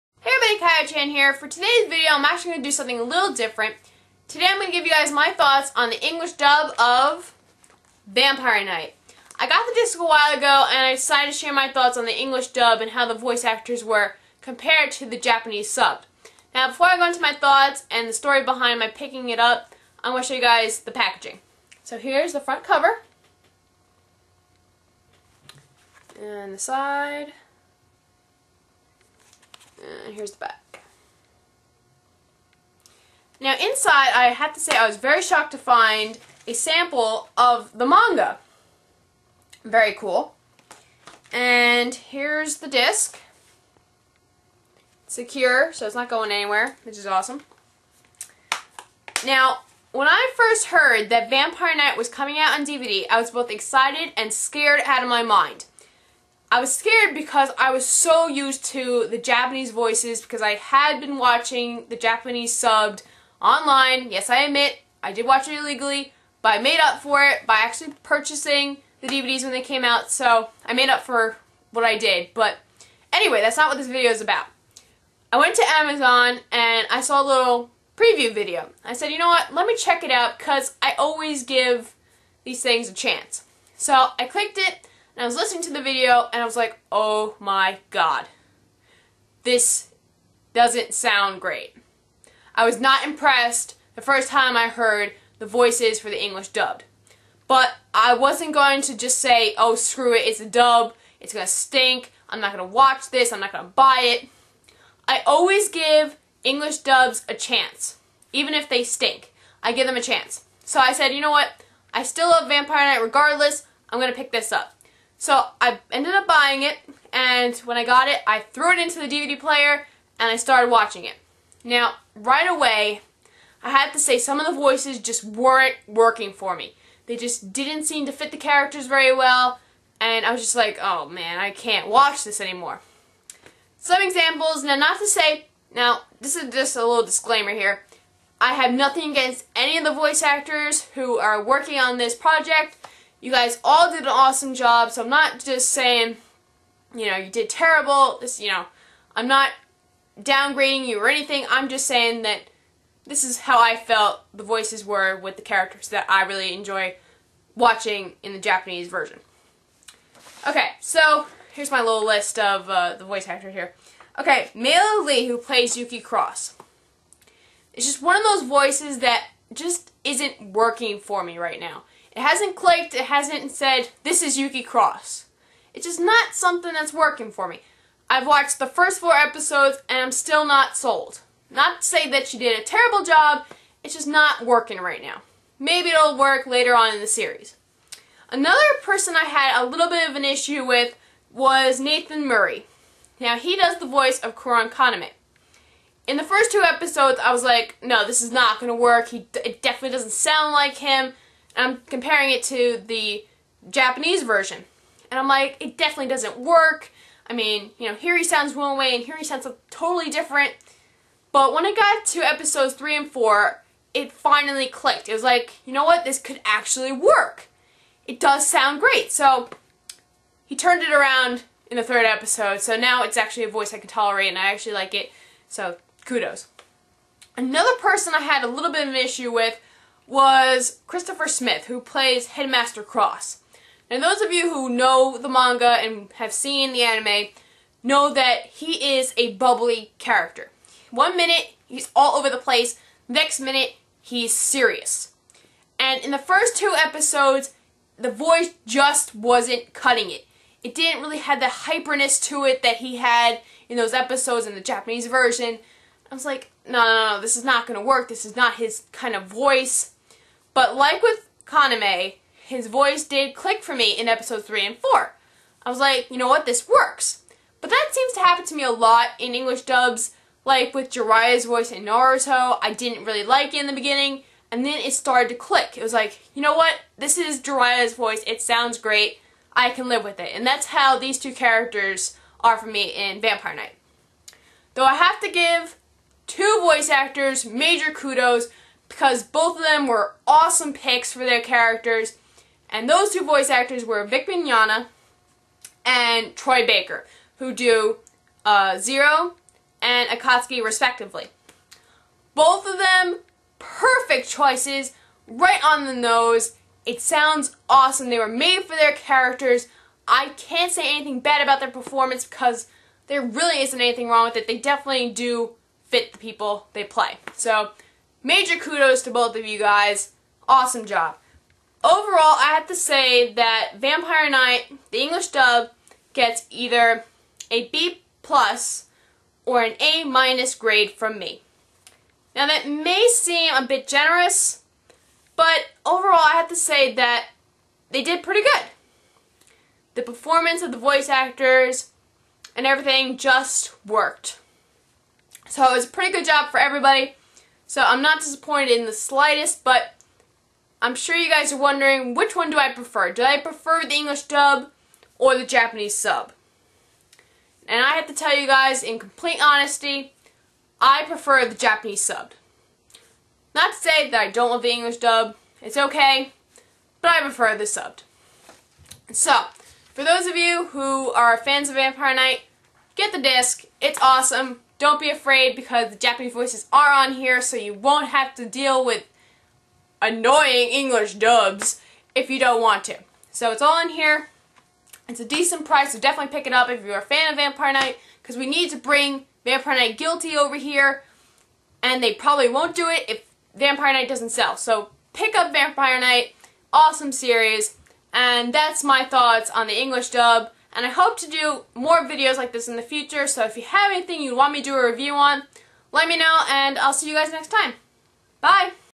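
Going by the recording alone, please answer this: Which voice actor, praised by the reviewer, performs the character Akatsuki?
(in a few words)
Troy Baker.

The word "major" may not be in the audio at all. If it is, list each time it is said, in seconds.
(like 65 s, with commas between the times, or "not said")
287 s, 318 s.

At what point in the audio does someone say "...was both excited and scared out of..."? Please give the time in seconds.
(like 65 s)
53 s.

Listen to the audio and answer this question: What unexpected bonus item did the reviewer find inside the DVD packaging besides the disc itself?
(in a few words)
sample of the manga.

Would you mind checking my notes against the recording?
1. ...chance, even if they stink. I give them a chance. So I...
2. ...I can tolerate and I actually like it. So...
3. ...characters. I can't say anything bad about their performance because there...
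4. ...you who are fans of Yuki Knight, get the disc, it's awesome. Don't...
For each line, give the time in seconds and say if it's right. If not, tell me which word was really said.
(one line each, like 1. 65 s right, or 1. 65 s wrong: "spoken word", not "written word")
1. 107 s right
2. 223 s right
3. 308 s right
4. 370 s wrong: "Vampire", not "Yuki".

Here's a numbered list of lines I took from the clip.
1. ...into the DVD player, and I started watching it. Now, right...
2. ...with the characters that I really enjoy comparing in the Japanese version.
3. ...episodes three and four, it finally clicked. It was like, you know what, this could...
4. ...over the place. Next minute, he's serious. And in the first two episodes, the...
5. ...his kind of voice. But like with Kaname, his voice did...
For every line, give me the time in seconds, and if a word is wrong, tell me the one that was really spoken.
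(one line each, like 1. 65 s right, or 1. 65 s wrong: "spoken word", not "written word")
1. 118 s right
2. 155 s wrong: "watching", not "comparing"
3. 212 s right
4. 242 s right
5. 258 s right.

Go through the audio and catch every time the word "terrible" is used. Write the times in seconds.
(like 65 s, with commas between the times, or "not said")
147 s, 182 s.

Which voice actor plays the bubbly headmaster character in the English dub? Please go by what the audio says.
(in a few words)
Christopher Smith.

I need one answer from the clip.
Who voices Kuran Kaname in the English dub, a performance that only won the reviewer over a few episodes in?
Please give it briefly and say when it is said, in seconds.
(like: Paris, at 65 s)
Nathan Murray, at 191 s.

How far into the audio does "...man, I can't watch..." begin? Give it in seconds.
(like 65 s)
131 s.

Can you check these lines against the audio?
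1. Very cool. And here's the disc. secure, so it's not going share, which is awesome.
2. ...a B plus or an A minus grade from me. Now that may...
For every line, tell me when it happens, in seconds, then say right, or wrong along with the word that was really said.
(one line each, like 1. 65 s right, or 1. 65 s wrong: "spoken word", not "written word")
1. 39 s wrong: "anywhere", not "share"
2. 327 s right.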